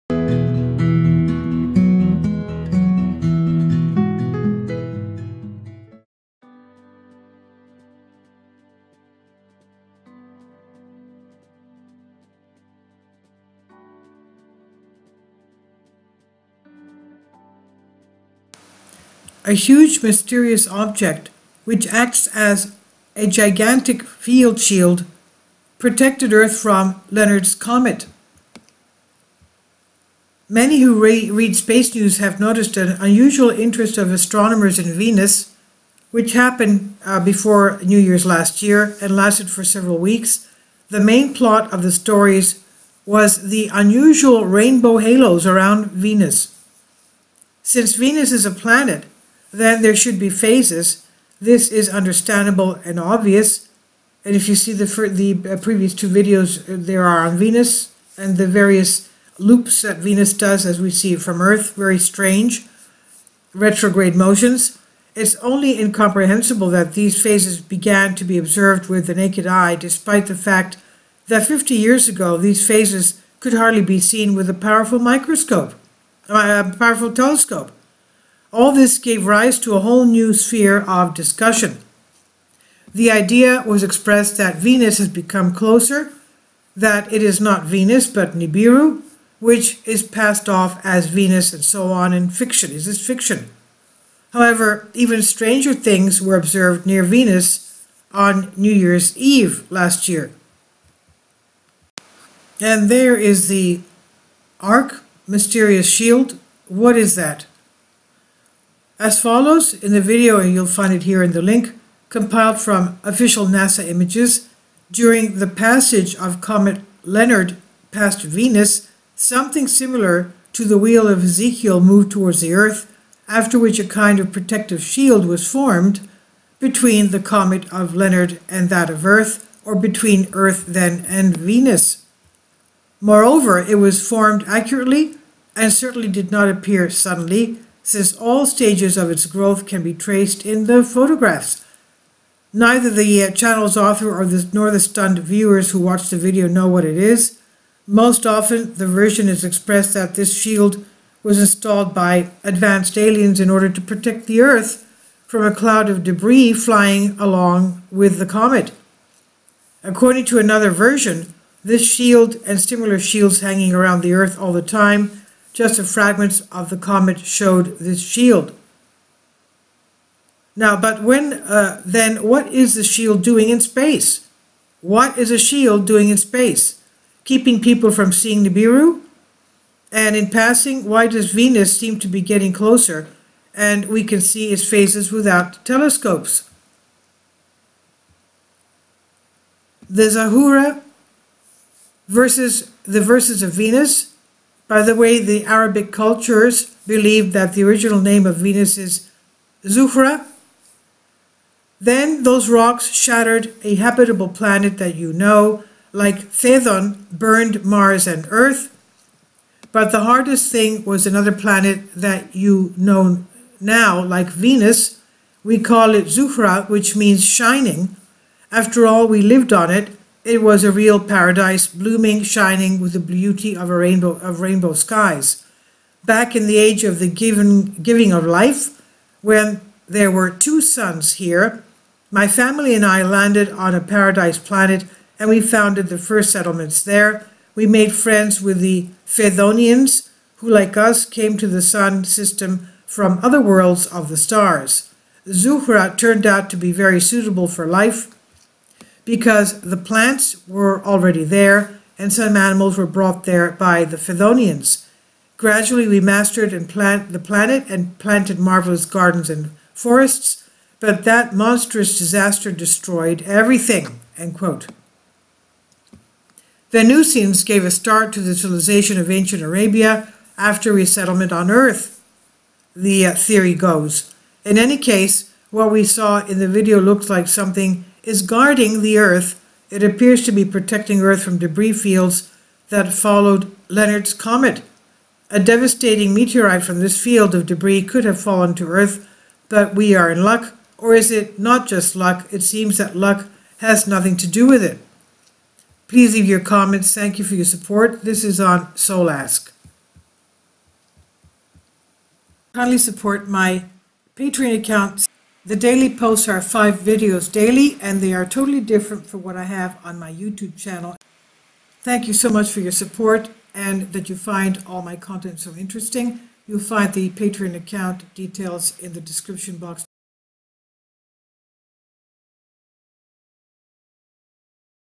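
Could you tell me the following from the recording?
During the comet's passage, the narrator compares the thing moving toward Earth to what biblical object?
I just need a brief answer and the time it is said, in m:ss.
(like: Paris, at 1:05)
The wheel of Ezekiel, at 2:00.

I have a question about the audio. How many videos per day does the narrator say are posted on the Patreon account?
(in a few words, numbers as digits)
5.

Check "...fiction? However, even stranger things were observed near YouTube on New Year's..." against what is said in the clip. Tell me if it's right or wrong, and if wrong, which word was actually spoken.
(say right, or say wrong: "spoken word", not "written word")
wrong: "Venus", not "YouTube".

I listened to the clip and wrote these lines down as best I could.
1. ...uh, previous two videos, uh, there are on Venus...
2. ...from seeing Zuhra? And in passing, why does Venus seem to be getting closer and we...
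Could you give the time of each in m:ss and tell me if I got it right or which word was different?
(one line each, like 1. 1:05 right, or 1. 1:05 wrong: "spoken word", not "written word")
1. 0:55 right
2. 2:57 wrong: "Nibiru", not "Zuhra".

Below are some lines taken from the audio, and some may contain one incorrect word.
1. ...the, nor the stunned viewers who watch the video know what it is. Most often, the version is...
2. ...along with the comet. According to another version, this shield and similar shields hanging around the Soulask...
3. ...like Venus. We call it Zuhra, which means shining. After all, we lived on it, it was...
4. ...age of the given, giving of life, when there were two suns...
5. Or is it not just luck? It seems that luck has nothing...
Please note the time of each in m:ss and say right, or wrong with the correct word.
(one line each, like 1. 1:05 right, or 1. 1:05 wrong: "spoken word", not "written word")
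1. 2:24 right
2. 2:37 wrong: "Earth", not "Soulask"
3. 3:34 right
4. 3:46 right
5. 4:50 right.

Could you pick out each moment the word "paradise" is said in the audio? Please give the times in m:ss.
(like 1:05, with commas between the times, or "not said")
3:40, 3:53.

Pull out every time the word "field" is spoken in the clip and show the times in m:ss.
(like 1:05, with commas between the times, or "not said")
0:24, 4:41, 4:47.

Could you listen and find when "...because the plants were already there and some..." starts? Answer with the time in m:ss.
4:09.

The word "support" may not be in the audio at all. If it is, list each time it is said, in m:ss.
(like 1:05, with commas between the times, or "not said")
4:57, 5:02, 5:12.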